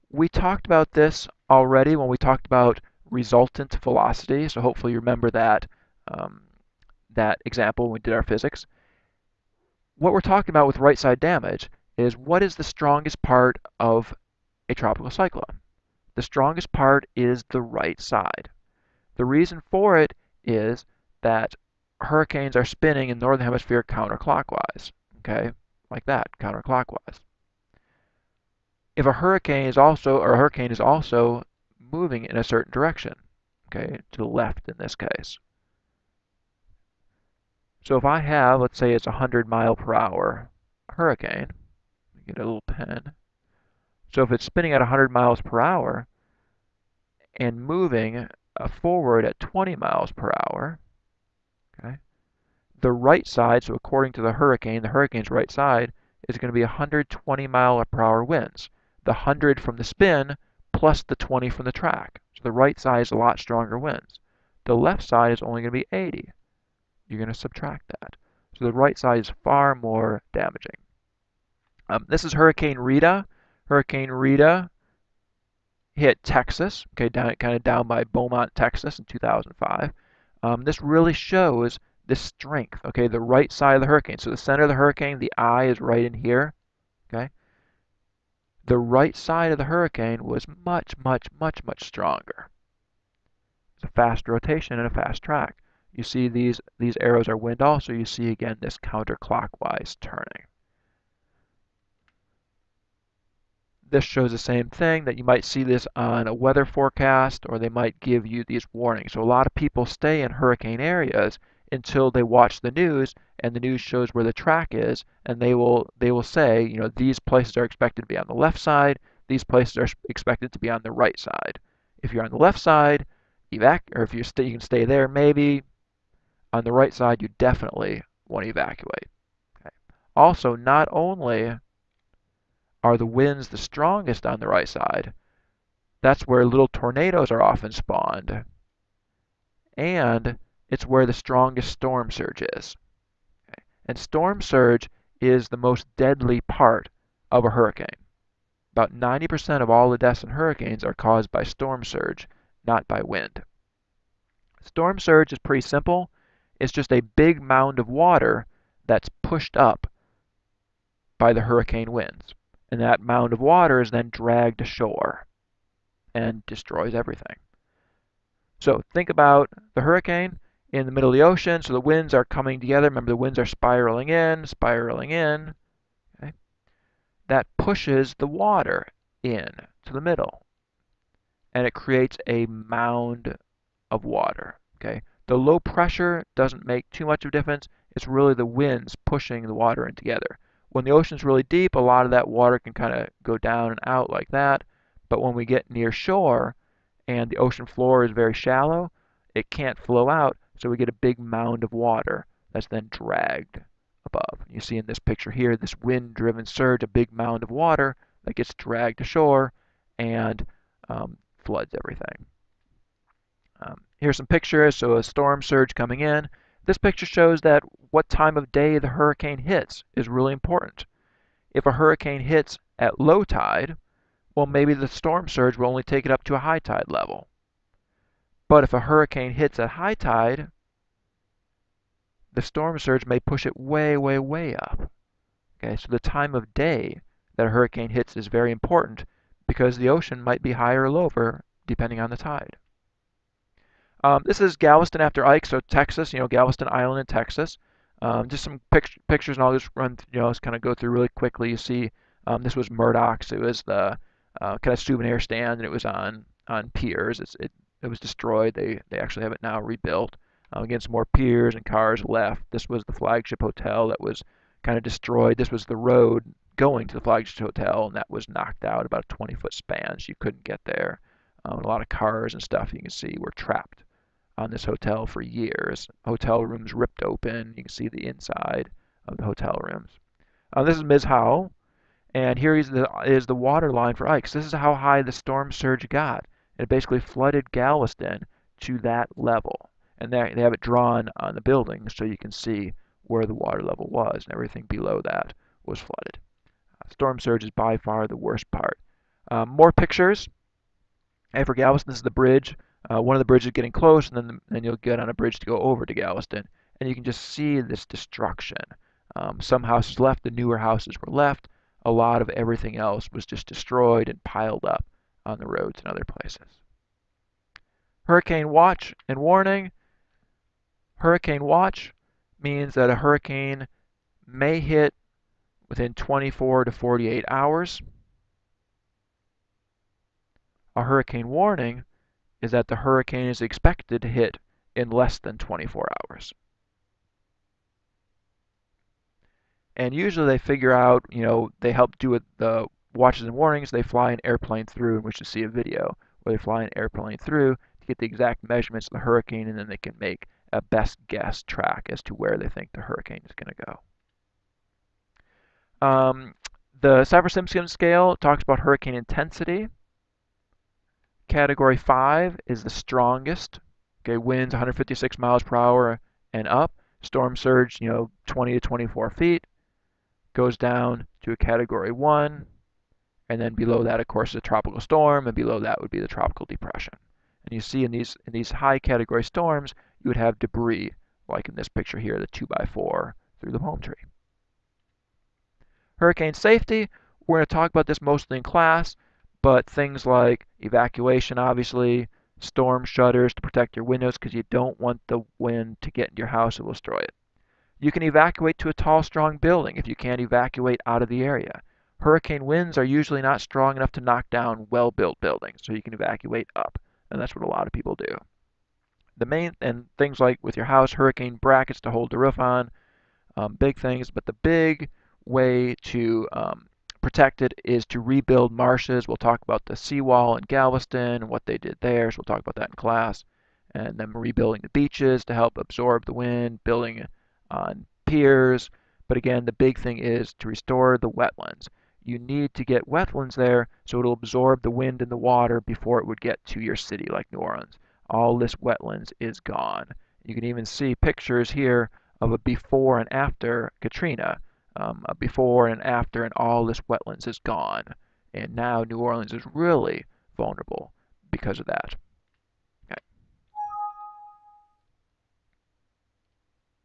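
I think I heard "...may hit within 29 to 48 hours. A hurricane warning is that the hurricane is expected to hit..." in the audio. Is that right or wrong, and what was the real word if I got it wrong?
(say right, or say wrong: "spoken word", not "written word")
wrong: "24", not "29".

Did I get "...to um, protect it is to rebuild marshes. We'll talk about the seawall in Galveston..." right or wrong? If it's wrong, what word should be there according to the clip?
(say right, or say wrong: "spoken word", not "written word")
right.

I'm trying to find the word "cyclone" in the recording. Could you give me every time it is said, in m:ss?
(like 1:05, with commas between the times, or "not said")
0:15.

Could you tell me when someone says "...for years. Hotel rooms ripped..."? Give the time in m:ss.
4:35.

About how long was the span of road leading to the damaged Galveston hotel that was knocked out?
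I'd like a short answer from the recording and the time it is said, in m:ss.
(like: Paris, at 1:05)
20 feet, at 4:29.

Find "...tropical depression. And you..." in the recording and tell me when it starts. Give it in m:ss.
6:16.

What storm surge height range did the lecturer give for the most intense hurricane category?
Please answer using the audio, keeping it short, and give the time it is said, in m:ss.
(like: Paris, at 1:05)
20 to 24 feet, at 6:08.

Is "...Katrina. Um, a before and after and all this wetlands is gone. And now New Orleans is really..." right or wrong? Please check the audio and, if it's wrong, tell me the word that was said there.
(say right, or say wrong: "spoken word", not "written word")
right.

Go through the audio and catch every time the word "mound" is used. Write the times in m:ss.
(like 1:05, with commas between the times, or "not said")
2:37, 2:43, 3:02, 3:21, 3:27.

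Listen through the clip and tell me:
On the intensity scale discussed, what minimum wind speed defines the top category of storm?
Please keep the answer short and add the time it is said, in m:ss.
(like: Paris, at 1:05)
156 mph, at 6:04.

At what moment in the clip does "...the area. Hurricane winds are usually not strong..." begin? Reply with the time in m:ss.
6:41.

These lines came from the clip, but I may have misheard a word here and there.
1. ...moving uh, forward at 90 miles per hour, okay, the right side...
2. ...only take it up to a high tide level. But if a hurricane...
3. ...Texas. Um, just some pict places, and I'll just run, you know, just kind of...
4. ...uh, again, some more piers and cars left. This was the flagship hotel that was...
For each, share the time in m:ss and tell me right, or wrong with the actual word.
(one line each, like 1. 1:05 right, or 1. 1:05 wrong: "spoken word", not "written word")
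1. 0:47 wrong: "20", not "90"
2. 3:45 right
3. 4:07 wrong: "pictures", not "places"
4. 4:20 right.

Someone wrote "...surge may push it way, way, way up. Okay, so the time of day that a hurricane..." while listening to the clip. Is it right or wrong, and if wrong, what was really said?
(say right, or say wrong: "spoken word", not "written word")
right.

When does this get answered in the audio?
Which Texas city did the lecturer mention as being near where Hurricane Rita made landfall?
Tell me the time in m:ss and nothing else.
1:18.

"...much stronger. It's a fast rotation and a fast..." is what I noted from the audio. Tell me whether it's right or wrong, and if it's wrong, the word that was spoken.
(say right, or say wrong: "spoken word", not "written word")
right.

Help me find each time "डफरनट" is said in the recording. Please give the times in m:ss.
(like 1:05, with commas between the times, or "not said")
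not said.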